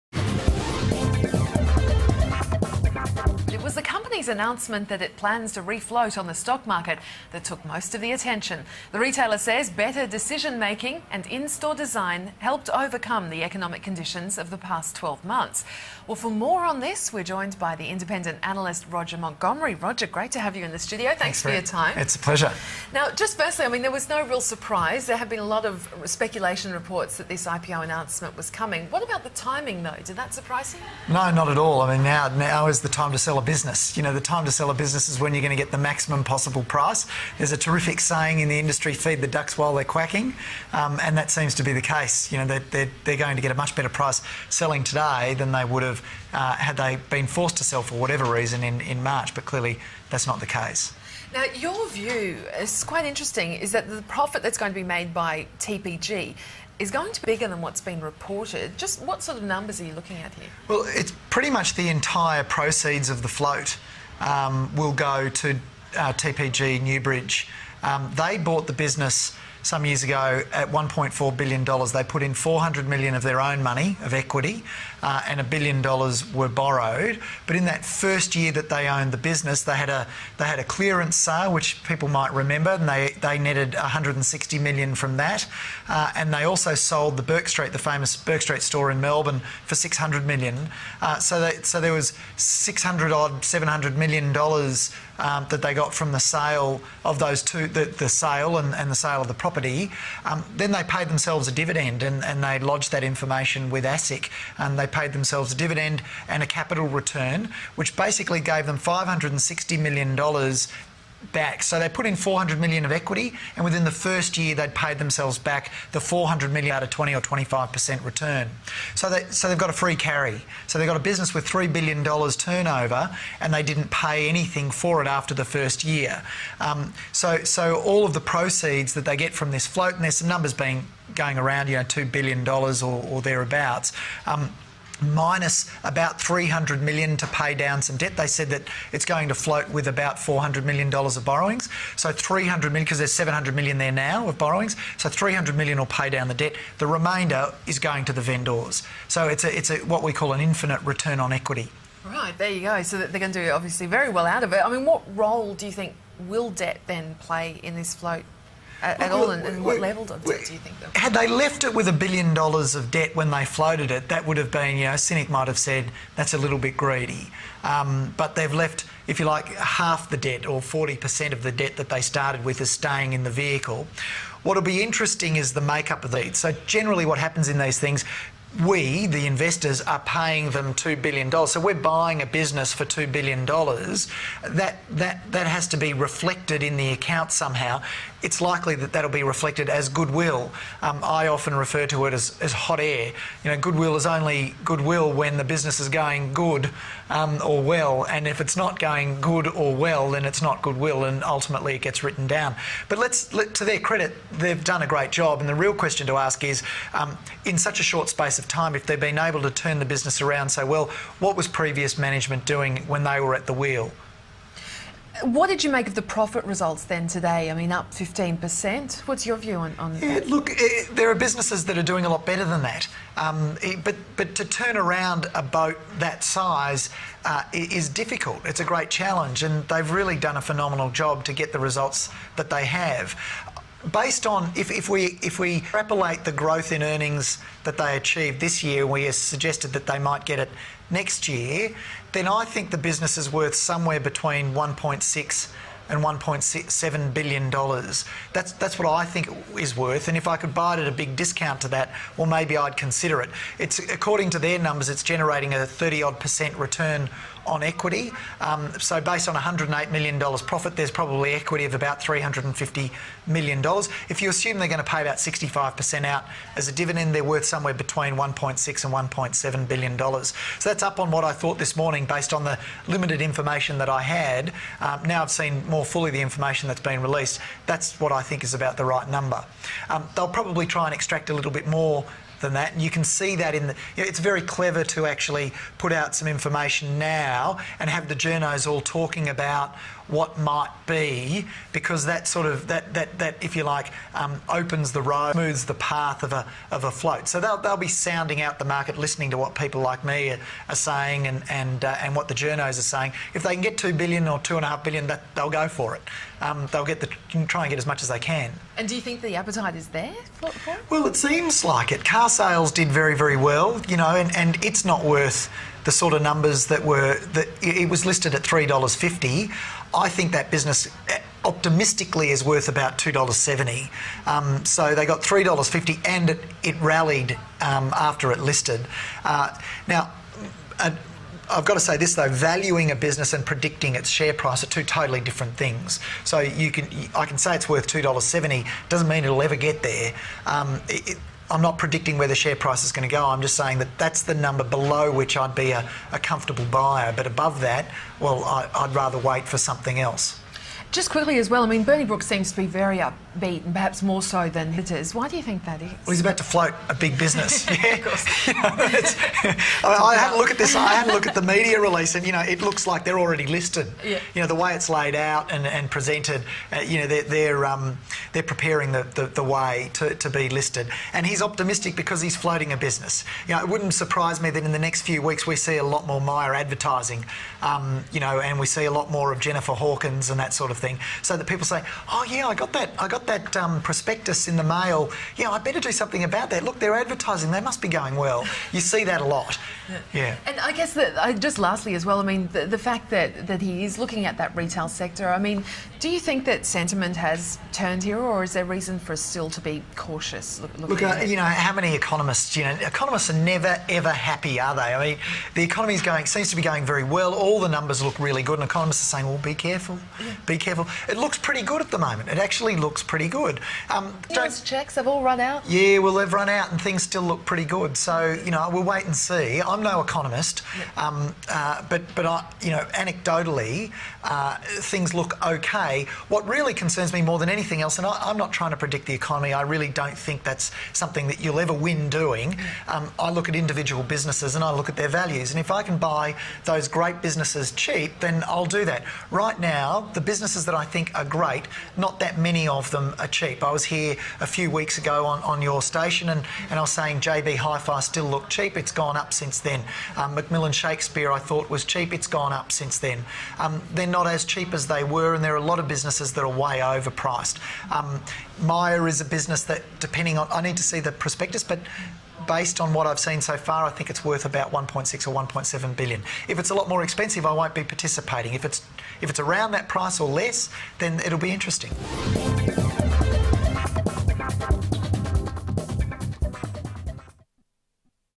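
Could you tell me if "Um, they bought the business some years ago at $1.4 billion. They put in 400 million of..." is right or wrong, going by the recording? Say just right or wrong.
right.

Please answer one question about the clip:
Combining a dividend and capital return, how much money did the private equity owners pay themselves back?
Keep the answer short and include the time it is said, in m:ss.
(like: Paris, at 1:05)
$560 million, at 1:48.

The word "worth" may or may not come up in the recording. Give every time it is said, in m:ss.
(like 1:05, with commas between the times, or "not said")
4:03, 4:09, 4:27, 5:15, 5:22, 5:37, 7:44.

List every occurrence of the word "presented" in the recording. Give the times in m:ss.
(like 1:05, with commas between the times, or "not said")
6:05.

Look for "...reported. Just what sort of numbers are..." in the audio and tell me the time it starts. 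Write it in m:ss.
0:58.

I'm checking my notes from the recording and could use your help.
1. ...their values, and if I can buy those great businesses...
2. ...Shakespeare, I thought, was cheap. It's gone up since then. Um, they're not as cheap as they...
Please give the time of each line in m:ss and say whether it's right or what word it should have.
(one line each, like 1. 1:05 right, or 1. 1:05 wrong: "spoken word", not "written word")
1. 7:14 right
2. 7:30 right.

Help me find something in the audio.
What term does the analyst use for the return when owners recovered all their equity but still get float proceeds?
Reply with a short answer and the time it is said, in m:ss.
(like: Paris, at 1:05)
Infinite return on equity, at 2:30.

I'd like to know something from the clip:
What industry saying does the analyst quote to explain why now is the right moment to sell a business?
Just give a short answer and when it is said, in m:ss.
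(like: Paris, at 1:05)
Feed the ducks while they're quacking, at 0:38.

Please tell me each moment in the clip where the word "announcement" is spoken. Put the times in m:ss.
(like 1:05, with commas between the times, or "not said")
0:04, 0:27.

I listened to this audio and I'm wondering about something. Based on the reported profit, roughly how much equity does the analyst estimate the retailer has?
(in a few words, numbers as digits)
$350 million.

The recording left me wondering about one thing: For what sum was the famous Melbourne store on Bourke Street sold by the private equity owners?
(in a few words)
$600 million.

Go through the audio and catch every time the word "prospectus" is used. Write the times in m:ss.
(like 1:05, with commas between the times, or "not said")
6:23, 7:41.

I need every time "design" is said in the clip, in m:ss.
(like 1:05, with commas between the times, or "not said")
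0:11.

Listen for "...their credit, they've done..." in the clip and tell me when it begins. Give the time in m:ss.
3:23.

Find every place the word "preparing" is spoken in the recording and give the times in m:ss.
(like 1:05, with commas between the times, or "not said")
6:08.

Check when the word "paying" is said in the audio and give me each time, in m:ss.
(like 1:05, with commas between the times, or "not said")
2:59.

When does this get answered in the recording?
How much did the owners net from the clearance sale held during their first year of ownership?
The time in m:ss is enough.
1:23.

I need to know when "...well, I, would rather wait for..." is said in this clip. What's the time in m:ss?
5:48.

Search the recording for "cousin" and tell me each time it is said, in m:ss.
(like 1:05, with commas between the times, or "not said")
not said.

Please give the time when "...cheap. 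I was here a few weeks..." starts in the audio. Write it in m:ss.
7:23.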